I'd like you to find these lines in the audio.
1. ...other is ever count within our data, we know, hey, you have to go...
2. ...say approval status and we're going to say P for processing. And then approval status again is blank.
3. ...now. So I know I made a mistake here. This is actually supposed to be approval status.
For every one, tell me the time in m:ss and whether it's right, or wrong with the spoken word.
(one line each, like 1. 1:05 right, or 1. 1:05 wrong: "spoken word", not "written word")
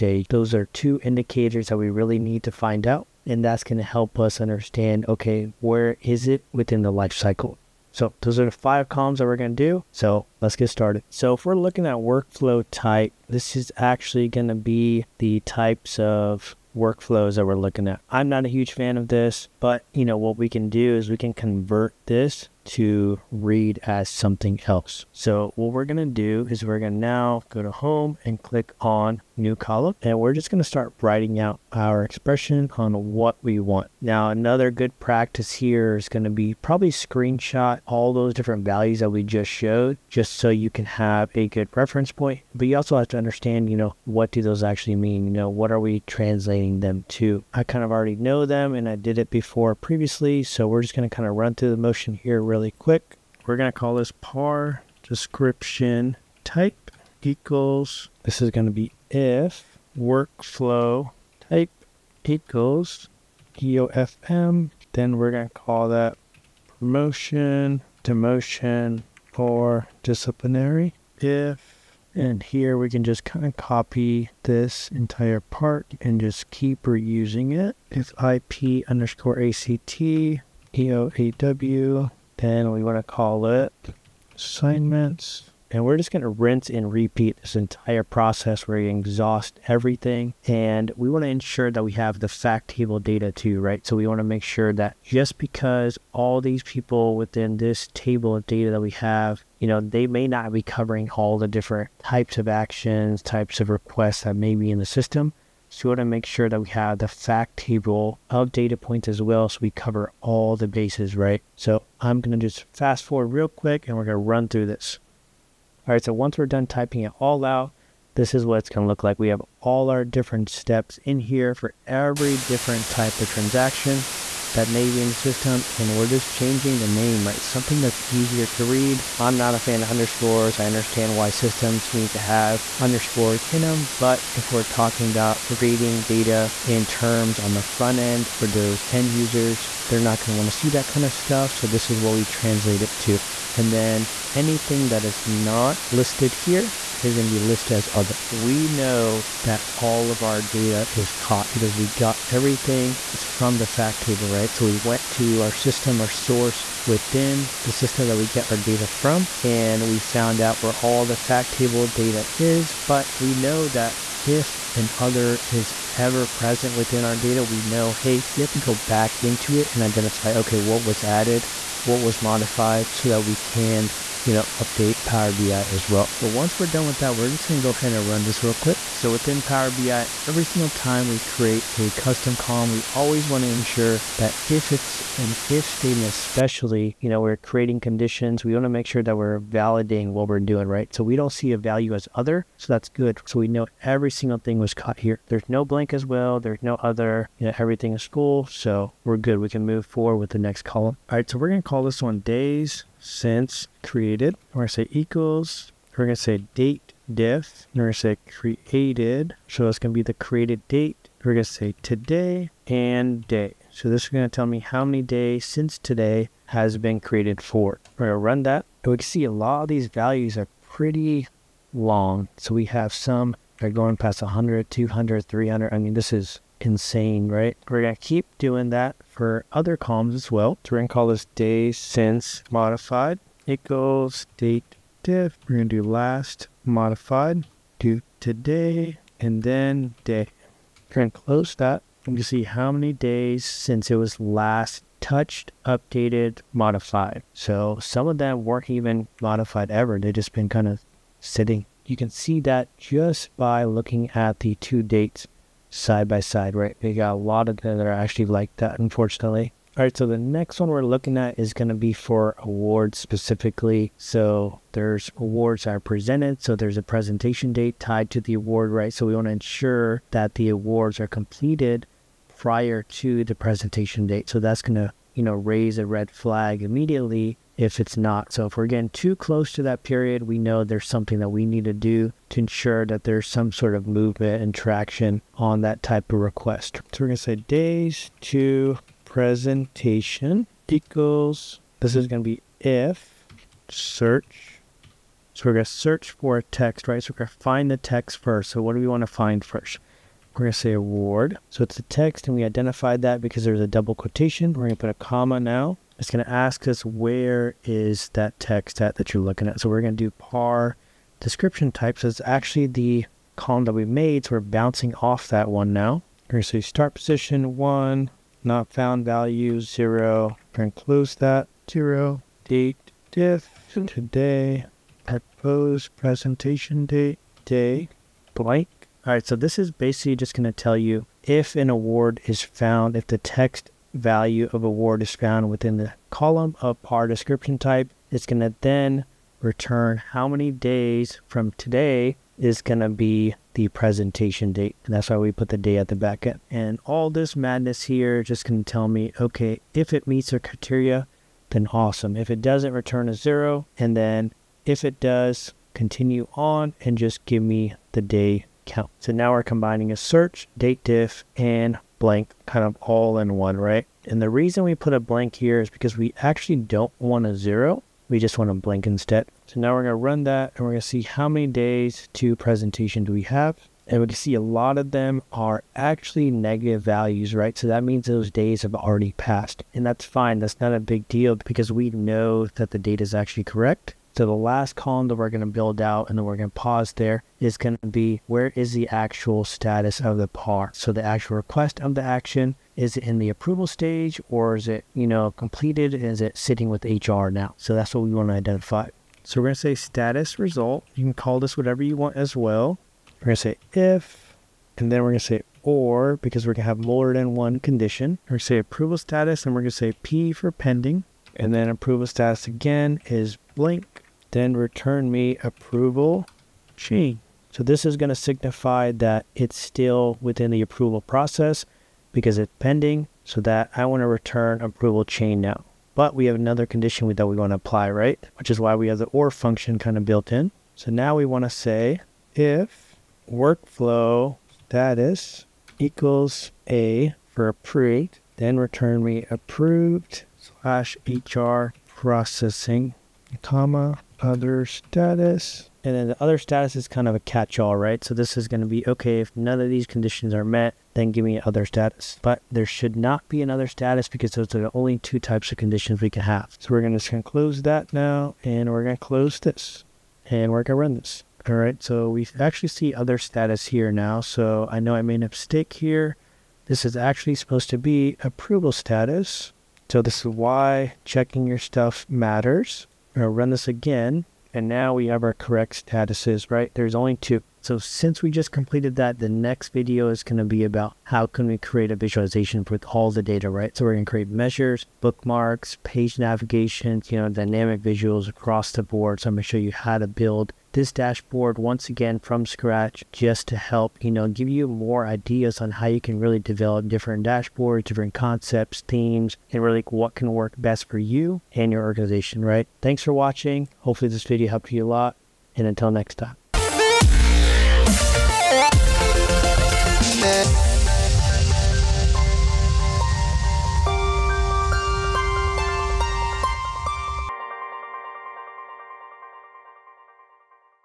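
1. 2:44 wrong: "present", not "count"
2. 6:48 wrong: "pending", not "processing"
3. 7:43 right.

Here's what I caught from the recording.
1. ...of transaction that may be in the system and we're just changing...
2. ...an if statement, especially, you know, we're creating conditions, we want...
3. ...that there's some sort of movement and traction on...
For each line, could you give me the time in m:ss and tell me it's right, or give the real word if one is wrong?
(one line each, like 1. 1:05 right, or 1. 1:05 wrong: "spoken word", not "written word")
1. 2:03 right
2. 3:05 right
3. 4:42 right.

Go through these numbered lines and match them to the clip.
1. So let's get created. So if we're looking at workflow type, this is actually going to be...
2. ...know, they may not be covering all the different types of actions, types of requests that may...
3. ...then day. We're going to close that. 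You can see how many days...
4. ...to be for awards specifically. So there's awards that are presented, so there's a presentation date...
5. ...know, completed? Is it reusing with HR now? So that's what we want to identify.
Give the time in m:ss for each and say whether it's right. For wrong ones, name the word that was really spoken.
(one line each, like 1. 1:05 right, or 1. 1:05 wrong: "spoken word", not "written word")
1. 0:09 wrong: "started", not "created"
2. 1:39 right
3. 3:59 right
4. 4:21 right
5. 6:35 wrong: "sitting", not "reusing".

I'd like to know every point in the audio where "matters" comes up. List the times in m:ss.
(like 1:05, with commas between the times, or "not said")
7:52.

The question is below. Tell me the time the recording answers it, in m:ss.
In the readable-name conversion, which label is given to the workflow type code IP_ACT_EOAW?
1:24.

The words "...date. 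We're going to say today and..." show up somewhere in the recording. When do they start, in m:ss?
3:30.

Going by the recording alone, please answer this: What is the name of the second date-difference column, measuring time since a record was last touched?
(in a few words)
Days since modified.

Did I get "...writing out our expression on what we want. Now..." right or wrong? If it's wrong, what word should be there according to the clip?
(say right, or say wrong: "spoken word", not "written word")
right.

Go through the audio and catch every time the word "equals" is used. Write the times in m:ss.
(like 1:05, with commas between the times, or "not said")
0:57, 1:02, 3:24, 3:53, 4:50, 7:15.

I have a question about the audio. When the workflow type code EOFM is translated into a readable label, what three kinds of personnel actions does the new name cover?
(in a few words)
Promotion, demotion, or disciplinary.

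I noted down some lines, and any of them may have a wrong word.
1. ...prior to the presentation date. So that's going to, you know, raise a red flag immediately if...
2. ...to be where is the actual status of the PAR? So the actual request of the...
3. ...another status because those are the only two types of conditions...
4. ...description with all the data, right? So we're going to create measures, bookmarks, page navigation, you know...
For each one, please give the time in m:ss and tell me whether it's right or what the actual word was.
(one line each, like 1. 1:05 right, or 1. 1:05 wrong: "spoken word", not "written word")
1. 4:32 right
2. 6:27 right
3. 7:33 right
4. 8:01 wrong: "visualization", not "description".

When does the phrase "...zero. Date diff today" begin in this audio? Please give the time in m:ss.
5:21.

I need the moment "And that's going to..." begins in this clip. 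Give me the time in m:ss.
0:03.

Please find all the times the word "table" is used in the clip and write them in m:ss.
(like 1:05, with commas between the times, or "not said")
1:32, 1:37, 1:47, 2:34, 2:41.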